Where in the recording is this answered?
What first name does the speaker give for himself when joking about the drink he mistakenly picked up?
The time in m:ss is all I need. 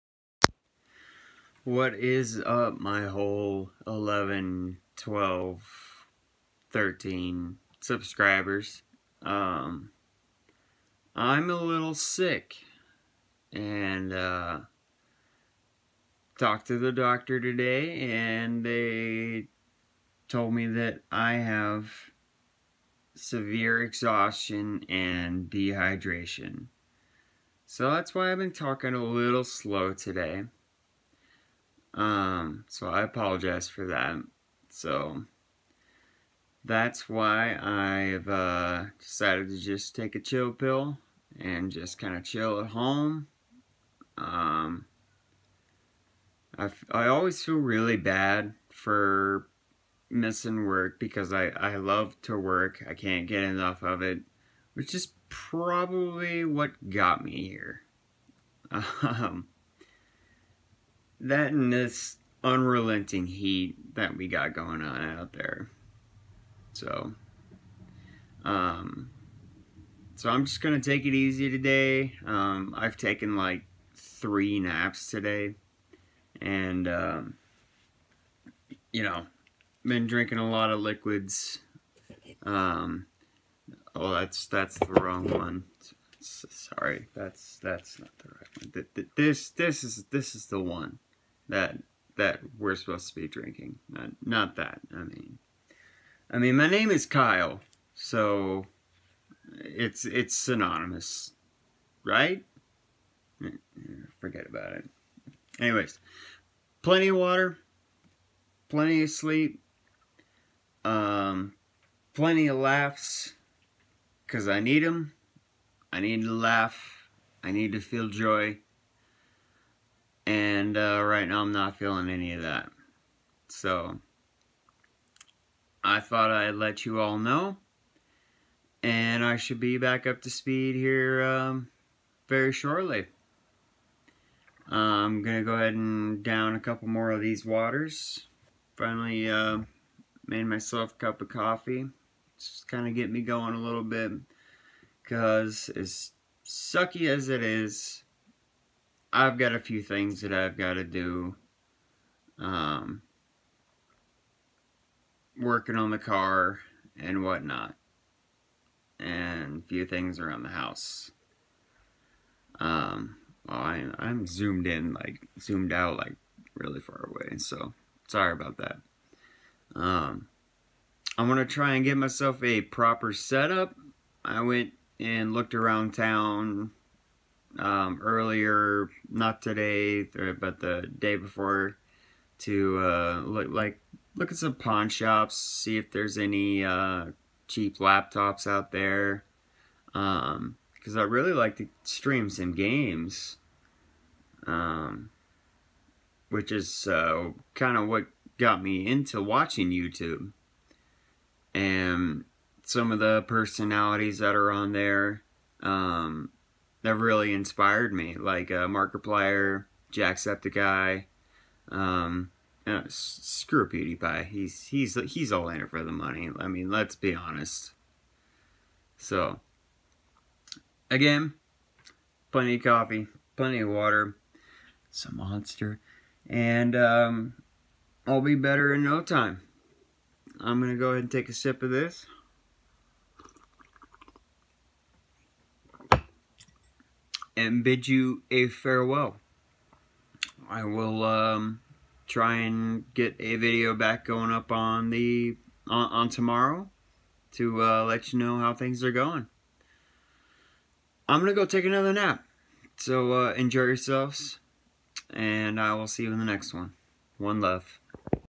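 1:37.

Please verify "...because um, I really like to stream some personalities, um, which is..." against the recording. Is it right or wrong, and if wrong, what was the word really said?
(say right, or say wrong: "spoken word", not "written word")
wrong: "games", not "personalities".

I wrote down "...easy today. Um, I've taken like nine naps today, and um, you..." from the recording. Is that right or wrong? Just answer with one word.
wrong.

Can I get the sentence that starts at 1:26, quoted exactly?
Sorry, that's that's not the right one.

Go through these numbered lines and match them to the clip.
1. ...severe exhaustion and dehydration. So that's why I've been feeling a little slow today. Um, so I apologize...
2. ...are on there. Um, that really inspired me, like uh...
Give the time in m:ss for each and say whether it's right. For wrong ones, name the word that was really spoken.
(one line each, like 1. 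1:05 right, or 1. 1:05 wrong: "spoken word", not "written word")
1. 0:23 wrong: "talking", not "feeling"
2. 3:24 right.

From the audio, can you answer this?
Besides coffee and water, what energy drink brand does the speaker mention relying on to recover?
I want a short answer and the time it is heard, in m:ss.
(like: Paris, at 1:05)
Monster, at 3:45.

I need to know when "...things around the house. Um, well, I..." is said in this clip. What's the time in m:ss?
2:39.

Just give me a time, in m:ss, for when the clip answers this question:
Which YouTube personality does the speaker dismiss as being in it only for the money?
3:33.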